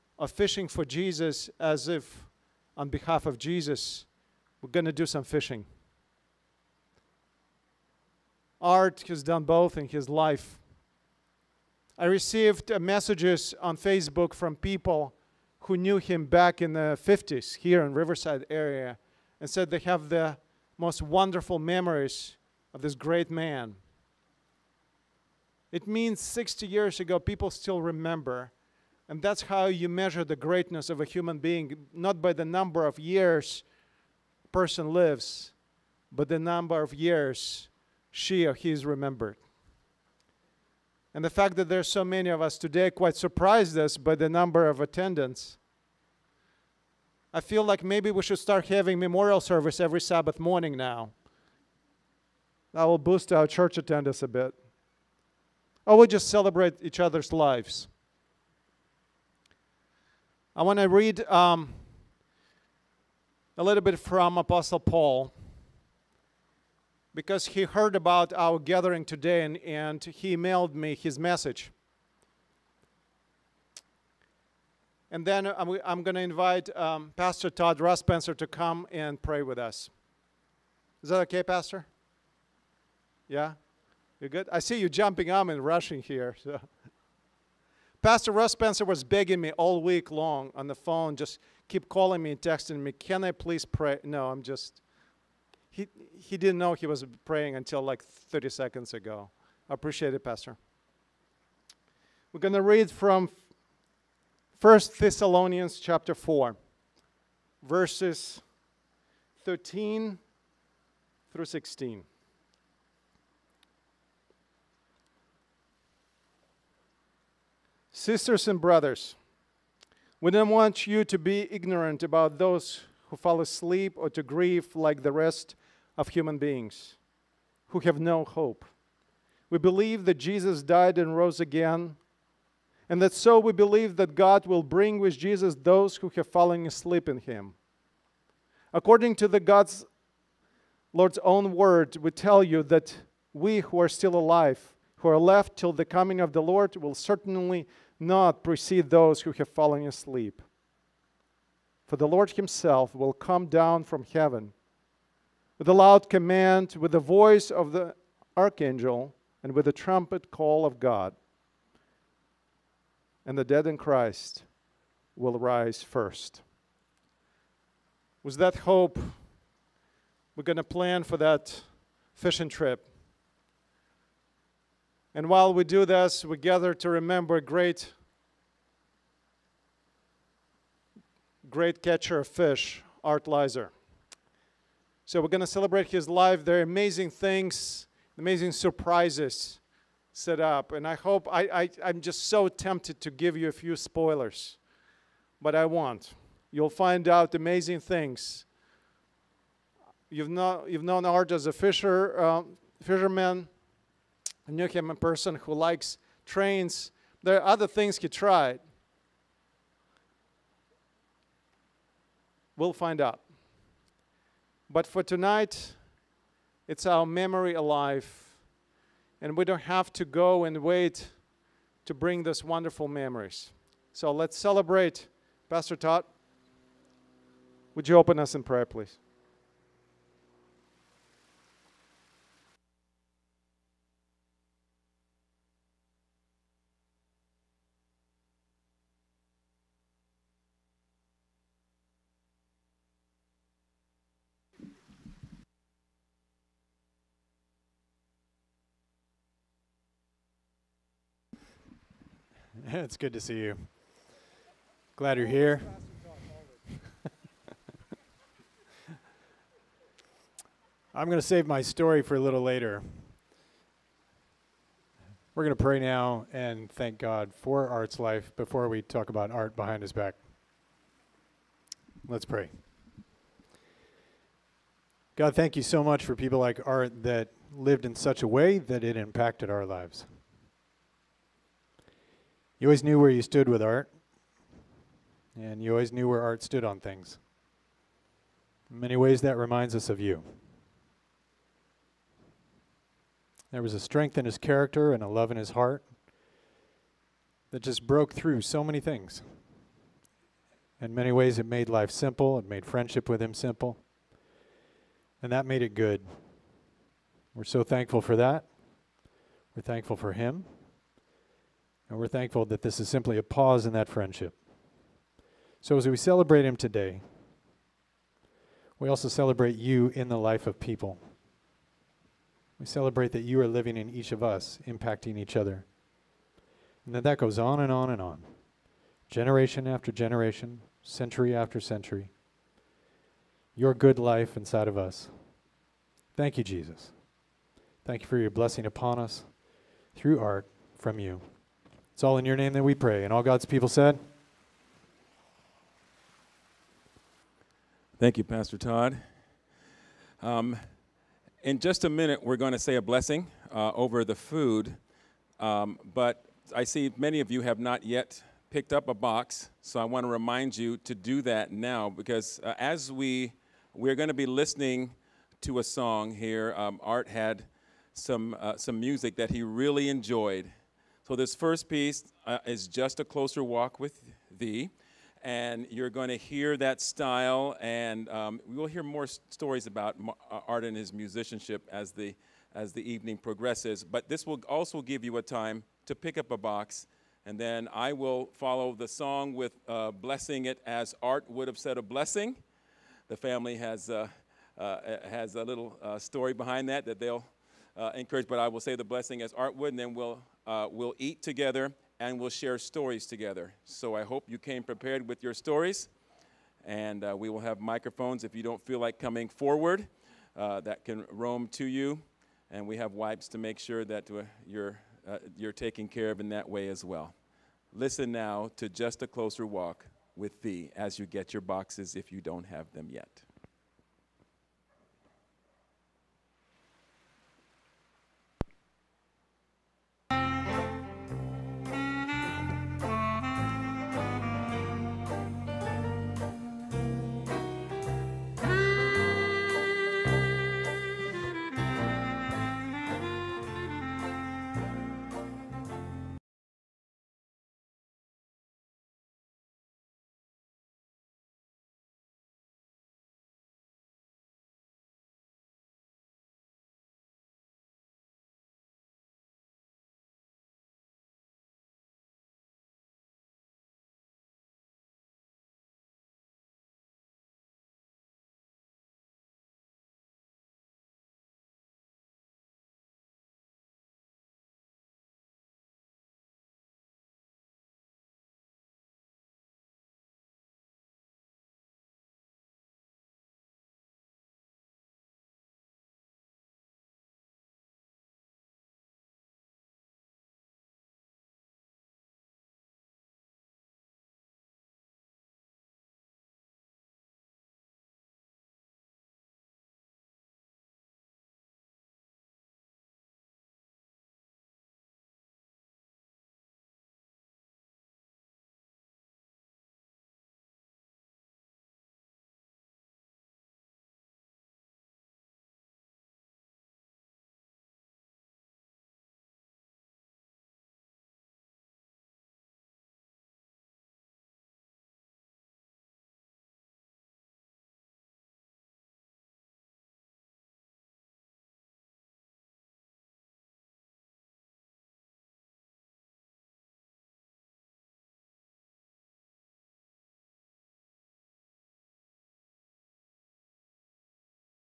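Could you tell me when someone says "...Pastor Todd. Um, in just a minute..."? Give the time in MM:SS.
05:48.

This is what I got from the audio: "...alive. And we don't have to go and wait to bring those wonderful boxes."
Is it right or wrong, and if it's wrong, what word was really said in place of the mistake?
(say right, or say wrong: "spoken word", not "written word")
wrong: "memories", not "boxes".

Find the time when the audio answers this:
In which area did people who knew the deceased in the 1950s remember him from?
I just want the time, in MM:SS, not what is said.
00:17.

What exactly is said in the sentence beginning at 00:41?
And the fact that there are so many of us today quite surprised us by the number of attendance.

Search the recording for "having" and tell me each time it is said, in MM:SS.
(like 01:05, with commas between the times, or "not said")
00:48.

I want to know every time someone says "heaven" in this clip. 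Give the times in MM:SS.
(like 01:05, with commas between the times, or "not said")
02:34.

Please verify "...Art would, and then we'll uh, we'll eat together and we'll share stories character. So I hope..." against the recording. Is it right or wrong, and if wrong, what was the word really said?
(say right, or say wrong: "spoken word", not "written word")
wrong: "together", not "character".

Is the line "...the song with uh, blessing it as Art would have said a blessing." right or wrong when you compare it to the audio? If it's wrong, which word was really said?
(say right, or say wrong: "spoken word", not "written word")
right.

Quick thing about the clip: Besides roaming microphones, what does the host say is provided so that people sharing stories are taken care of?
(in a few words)
Wipes.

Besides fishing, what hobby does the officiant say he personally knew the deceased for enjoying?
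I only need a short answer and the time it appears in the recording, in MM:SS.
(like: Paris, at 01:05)
Trains, at 03:26.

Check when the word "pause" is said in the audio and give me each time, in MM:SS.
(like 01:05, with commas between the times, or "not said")
05:13.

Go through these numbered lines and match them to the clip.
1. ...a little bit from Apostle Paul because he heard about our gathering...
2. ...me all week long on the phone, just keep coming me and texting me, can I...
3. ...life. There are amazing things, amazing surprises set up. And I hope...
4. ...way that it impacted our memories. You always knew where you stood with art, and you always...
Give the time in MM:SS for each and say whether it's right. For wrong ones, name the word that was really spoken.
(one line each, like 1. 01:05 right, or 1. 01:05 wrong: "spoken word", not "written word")
1. 01:03 right
2. 01:29 wrong: "calling", not "coming"
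3. 03:06 right
4. 04:38 wrong: "lives", not "memories".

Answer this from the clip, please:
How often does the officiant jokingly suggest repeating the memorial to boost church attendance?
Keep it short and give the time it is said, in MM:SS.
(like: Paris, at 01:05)
Every Sabbath morning, at 00:49.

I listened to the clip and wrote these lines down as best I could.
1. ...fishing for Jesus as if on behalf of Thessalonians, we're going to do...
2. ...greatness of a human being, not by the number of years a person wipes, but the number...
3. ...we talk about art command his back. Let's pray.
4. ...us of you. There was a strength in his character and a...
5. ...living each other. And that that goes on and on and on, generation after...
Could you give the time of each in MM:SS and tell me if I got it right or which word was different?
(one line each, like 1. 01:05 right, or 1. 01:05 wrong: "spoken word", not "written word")
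1. 00:00 wrong: "Jesus", not "Thessalonians"
2. 00:30 wrong: "lives", not "wipes"
3. 04:28 wrong: "behind", not "command"
4. 04:49 right
5. 05:24 wrong: "impacting", not "living".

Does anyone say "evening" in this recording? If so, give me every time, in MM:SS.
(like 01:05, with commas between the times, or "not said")
06:22.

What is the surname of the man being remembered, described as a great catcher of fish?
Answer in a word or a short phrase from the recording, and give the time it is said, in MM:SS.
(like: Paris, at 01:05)
Lizer, at 03:03.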